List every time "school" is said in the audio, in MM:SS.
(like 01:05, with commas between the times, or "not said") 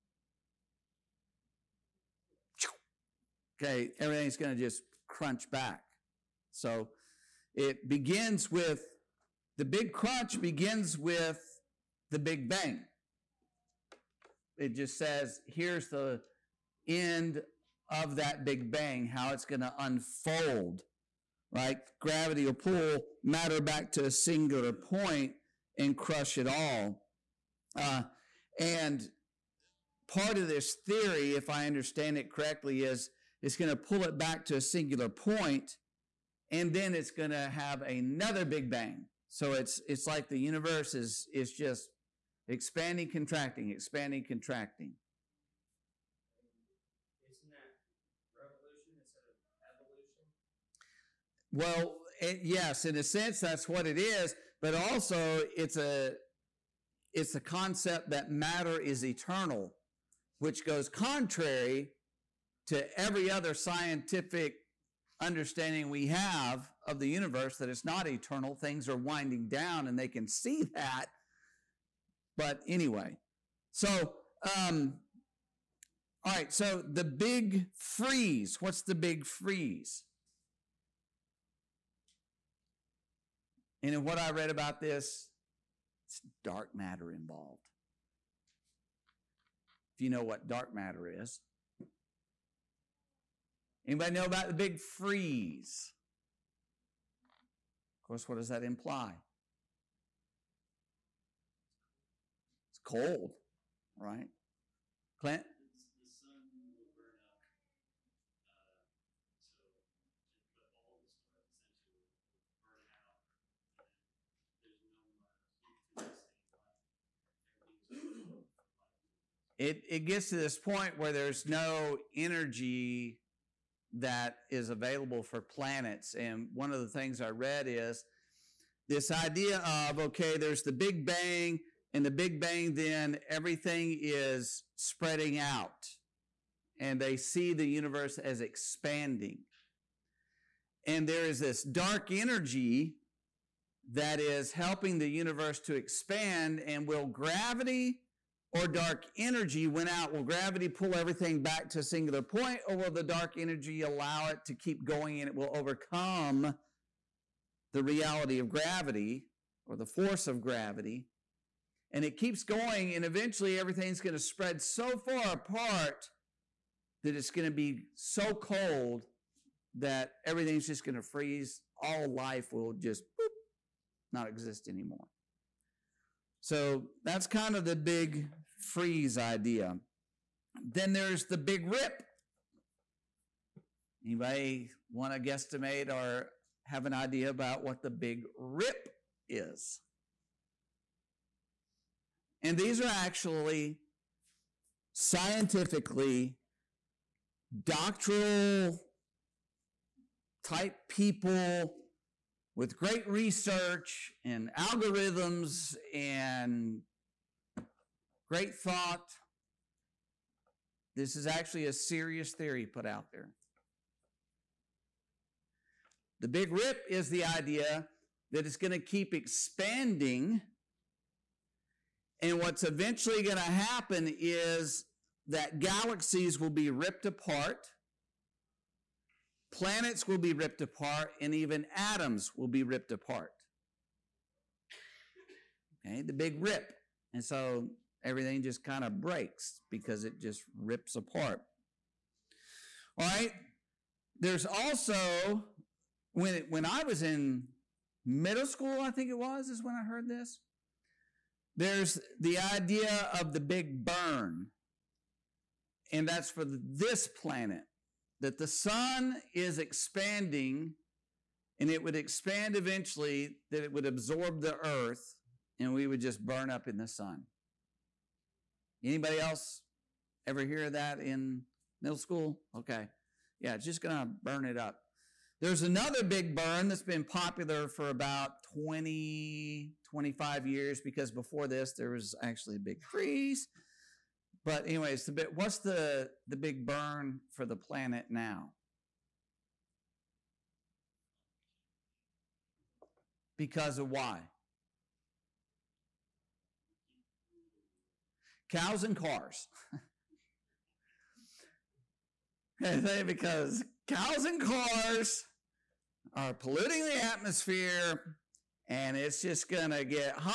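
04:08, 04:31.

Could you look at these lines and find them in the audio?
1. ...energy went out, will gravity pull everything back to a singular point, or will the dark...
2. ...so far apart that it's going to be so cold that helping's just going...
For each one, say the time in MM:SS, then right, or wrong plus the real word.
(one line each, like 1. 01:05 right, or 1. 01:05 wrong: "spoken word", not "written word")
1. 02:29 right
2. 02:44 wrong: "everything", not "helping".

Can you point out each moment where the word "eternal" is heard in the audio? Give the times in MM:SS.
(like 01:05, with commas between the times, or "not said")
00:59, 01:08.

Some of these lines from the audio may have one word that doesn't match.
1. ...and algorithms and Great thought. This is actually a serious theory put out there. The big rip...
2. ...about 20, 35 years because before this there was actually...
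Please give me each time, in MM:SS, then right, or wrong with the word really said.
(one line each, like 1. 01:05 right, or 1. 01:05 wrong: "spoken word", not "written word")
1. 03:24 right
2. 04:37 wrong: "25", not "35".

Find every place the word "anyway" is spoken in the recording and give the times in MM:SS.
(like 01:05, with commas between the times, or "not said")
01:12, 04:44.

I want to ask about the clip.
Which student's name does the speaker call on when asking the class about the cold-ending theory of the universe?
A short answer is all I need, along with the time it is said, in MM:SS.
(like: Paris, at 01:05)
Clint, at 01:45.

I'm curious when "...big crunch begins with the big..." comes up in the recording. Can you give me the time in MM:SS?
00:09.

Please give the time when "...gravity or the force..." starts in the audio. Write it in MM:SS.
02:38.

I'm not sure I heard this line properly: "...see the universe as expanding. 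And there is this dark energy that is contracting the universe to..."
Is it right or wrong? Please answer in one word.
wrong.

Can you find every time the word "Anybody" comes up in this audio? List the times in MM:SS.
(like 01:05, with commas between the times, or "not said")
01:33, 03:04, 04:28.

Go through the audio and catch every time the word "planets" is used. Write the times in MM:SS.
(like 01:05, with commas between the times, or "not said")
02:05, 03:49, 04:17, 04:47.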